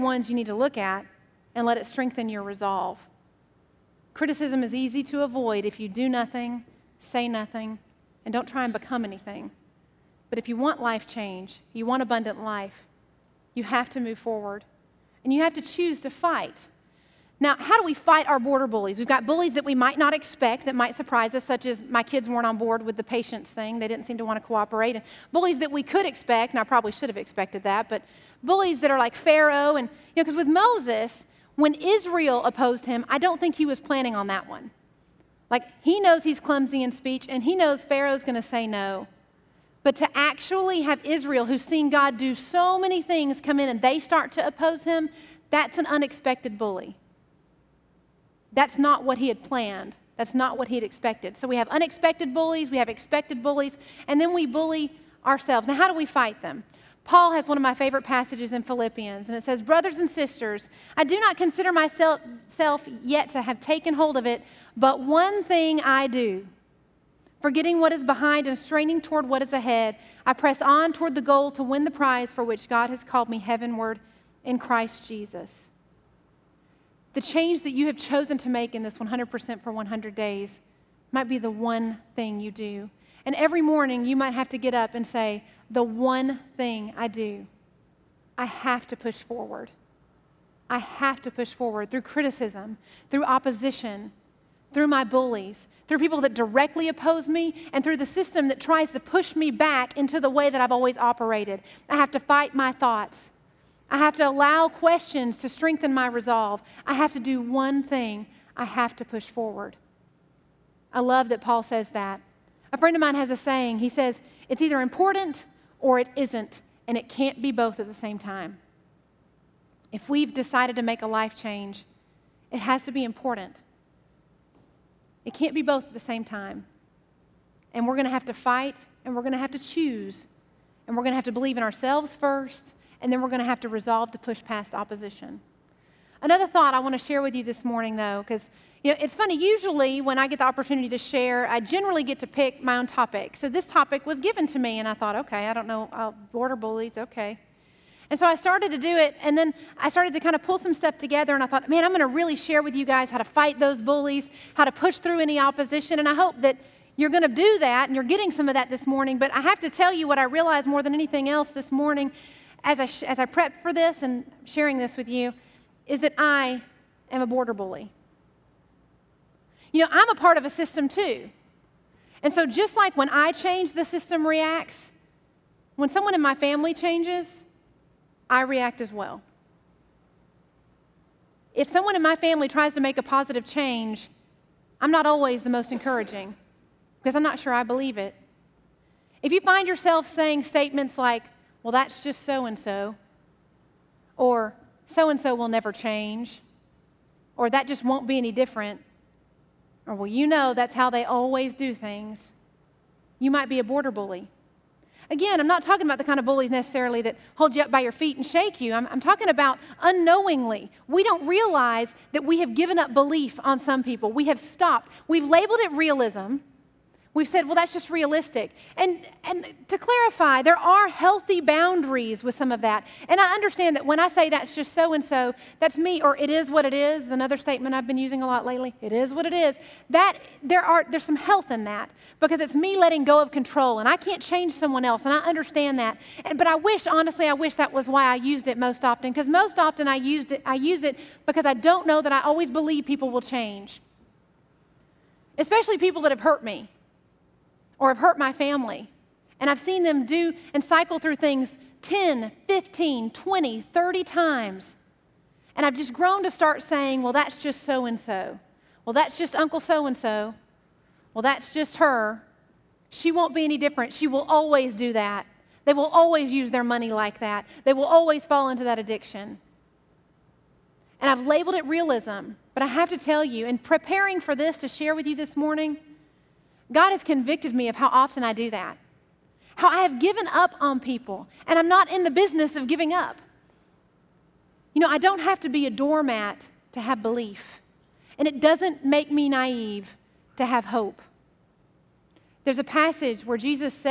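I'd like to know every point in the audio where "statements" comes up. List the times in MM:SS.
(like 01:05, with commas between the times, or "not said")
03:10, 03:47.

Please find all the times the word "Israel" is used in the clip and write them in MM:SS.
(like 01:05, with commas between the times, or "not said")
00:31, 00:41.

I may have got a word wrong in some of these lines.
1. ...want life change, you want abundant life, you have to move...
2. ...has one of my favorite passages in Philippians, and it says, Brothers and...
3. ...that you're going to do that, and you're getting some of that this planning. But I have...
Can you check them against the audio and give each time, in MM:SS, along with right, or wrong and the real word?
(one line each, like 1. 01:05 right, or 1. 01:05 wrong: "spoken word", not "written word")
1. 00:10 right
2. 00:57 right
3. 02:36 wrong: "morning", not "planning".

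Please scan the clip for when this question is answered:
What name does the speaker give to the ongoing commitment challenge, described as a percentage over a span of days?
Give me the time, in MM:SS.
01:18.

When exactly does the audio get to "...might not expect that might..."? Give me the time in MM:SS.
00:19.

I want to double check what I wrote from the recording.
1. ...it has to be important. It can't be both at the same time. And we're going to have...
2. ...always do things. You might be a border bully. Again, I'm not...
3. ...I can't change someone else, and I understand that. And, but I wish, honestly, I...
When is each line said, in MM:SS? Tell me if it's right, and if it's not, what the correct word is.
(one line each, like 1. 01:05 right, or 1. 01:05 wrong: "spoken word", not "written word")
1. 02:02 right
2. 03:21 right
3. 03:53 right.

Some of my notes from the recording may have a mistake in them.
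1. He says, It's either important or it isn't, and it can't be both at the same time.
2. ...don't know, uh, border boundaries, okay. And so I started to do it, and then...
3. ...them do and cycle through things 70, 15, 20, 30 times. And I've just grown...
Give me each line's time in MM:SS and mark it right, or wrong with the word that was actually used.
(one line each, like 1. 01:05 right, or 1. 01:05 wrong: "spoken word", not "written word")
1. 01:53 right
2. 02:25 wrong: "bullies", not "boundaries"
3. 04:09 wrong: "10", not "70".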